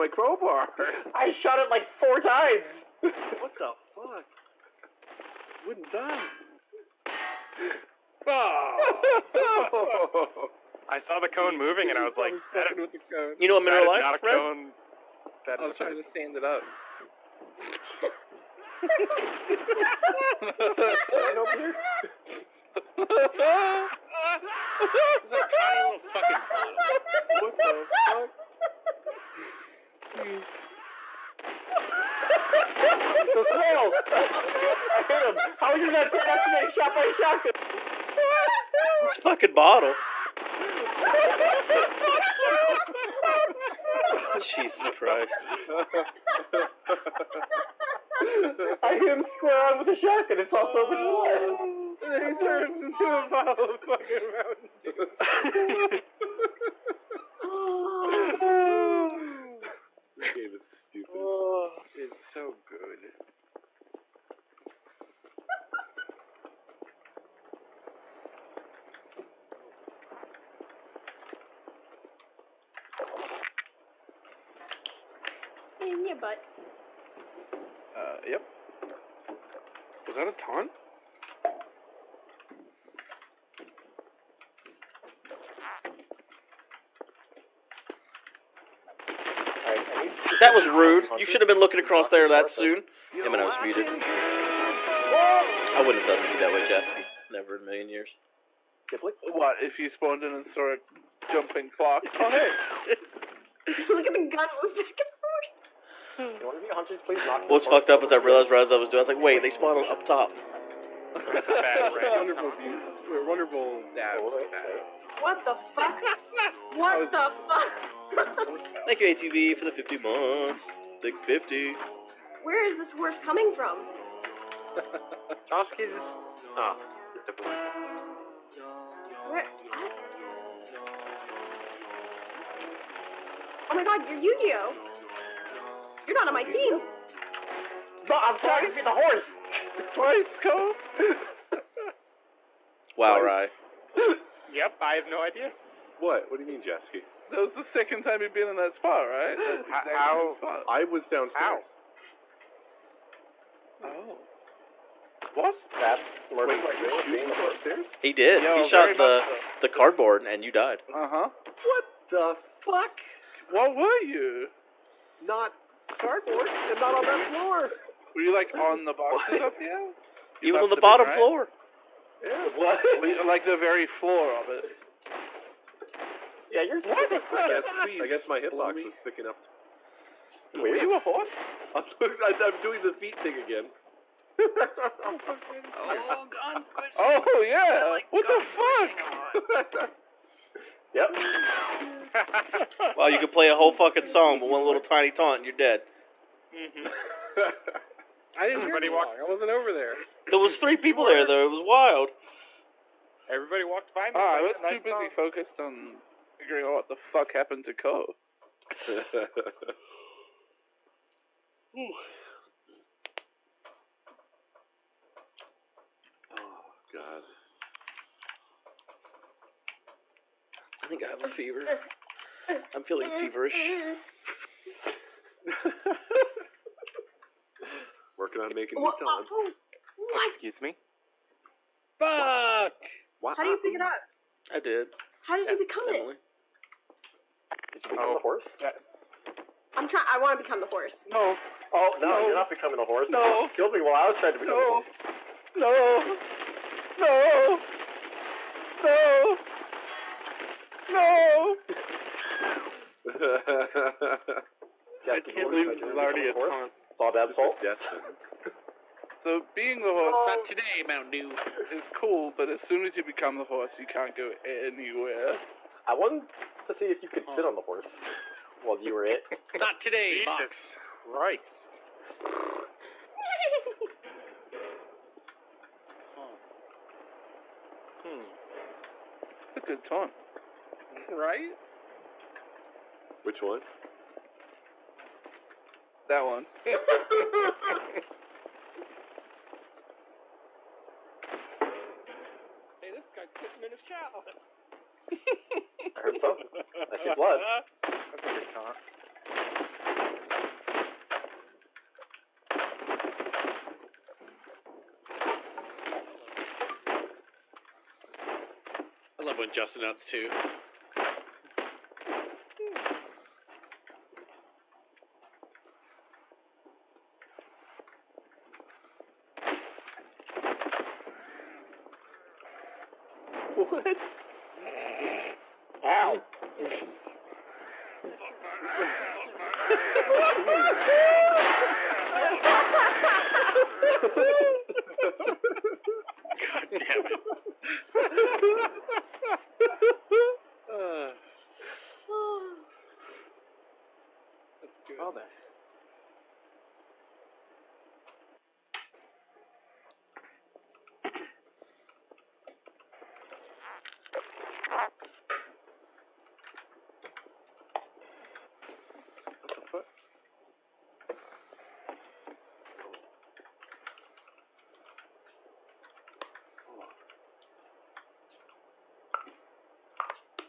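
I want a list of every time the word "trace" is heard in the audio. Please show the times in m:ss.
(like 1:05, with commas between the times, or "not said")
not said.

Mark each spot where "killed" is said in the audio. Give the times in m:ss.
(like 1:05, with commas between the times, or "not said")
4:03.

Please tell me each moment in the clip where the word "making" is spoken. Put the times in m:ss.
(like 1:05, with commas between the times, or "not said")
3:48.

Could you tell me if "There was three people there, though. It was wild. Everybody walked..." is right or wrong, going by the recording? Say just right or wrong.
right.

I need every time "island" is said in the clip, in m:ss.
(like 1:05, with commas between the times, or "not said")
not said.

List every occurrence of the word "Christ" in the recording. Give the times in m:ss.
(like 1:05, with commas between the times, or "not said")
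0:44, 4:31.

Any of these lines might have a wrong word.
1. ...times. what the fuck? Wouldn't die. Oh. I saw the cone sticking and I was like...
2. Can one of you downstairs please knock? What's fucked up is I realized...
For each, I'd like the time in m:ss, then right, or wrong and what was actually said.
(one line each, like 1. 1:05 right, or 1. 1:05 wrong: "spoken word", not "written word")
1. 0:02 wrong: "moving", not "sticking"
2. 1:46 wrong: "hunters", not "downstairs".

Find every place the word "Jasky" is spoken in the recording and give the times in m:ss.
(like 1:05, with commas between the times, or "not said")
1:36, 2:26.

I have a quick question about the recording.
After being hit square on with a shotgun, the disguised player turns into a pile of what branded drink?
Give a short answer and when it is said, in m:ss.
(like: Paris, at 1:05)
Mountain Dew, at 0:54.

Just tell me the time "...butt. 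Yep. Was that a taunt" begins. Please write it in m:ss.
1:16.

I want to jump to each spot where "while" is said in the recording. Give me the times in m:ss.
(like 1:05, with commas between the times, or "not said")
4:03, 4:28.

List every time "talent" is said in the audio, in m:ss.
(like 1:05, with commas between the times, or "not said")
3:48.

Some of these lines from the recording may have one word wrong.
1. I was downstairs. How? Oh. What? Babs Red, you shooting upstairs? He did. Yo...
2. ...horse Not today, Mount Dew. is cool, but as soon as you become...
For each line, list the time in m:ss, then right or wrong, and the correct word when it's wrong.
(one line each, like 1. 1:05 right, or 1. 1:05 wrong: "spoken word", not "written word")
1. 2:30 wrong: "Wait", not "Red"
2. 4:19 right.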